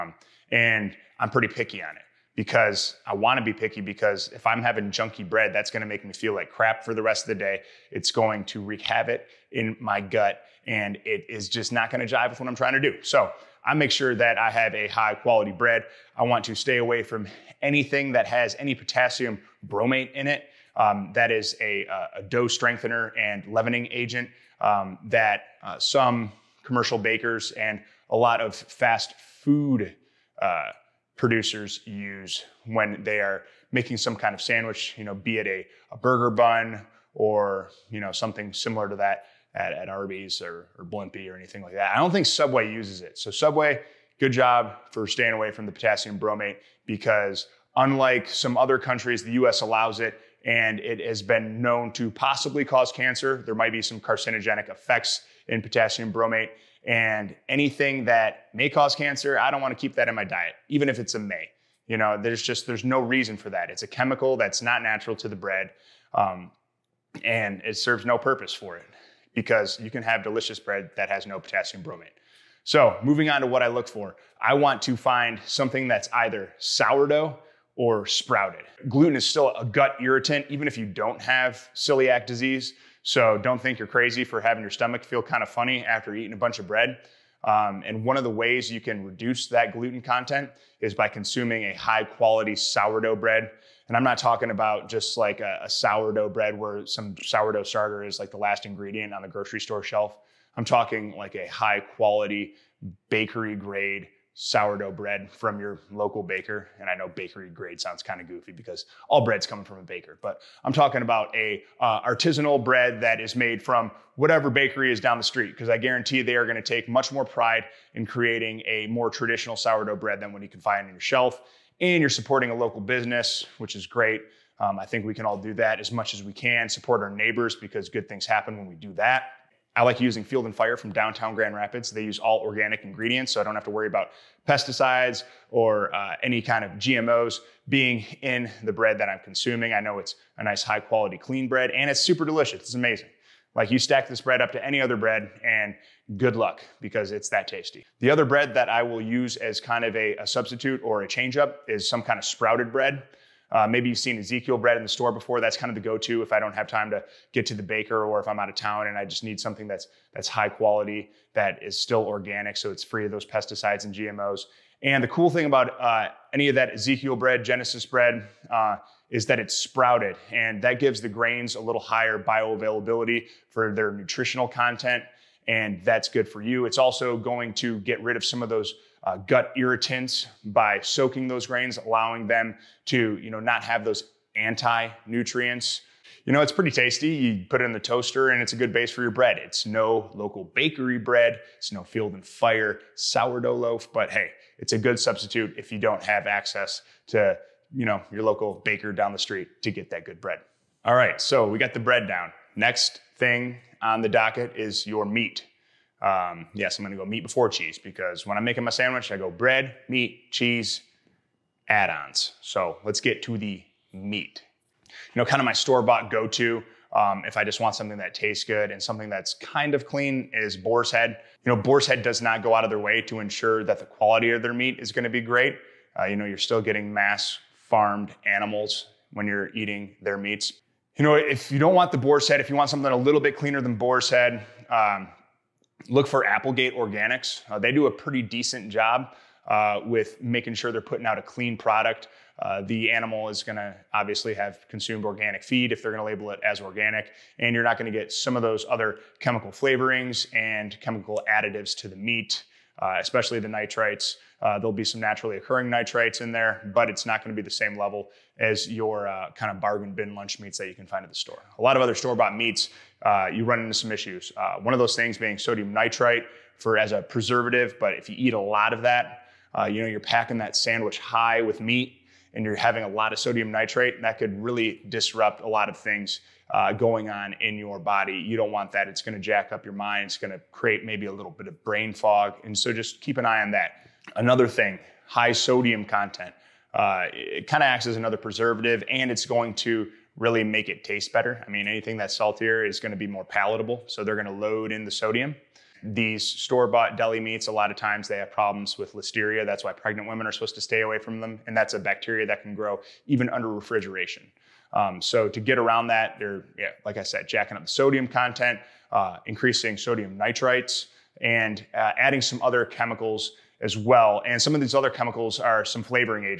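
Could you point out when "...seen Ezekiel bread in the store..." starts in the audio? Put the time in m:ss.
2:33.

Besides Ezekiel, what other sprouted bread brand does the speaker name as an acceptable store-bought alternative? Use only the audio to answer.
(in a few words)
Genesis.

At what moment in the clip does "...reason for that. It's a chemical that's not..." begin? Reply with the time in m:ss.
1:03.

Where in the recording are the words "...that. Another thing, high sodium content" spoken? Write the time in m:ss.
4:43.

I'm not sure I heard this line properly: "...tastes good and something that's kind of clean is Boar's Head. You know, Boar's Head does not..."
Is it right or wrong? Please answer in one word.
right.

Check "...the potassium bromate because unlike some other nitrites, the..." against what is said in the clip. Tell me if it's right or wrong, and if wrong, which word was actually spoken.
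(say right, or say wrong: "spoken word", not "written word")
wrong: "countries", not "nitrites".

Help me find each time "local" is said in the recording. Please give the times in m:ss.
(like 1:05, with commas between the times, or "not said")
1:45, 2:02, 3:10, 3:18.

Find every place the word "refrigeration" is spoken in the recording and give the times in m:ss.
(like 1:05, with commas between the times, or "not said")
5:03.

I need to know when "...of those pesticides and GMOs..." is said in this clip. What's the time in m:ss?
2:43.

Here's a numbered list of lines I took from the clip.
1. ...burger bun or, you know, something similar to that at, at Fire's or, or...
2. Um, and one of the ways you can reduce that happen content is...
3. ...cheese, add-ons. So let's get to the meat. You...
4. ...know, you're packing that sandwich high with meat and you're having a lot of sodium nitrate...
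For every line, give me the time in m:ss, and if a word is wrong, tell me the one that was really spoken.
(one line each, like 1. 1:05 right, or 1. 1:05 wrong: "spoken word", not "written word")
1. 0:35 wrong: "Arby", not "Fire"
2. 1:27 wrong: "gluten", not "happen"
3. 3:30 right
4. 4:29 right.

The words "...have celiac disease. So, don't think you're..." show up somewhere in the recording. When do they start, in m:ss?
1:21.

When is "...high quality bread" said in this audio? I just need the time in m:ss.
0:14.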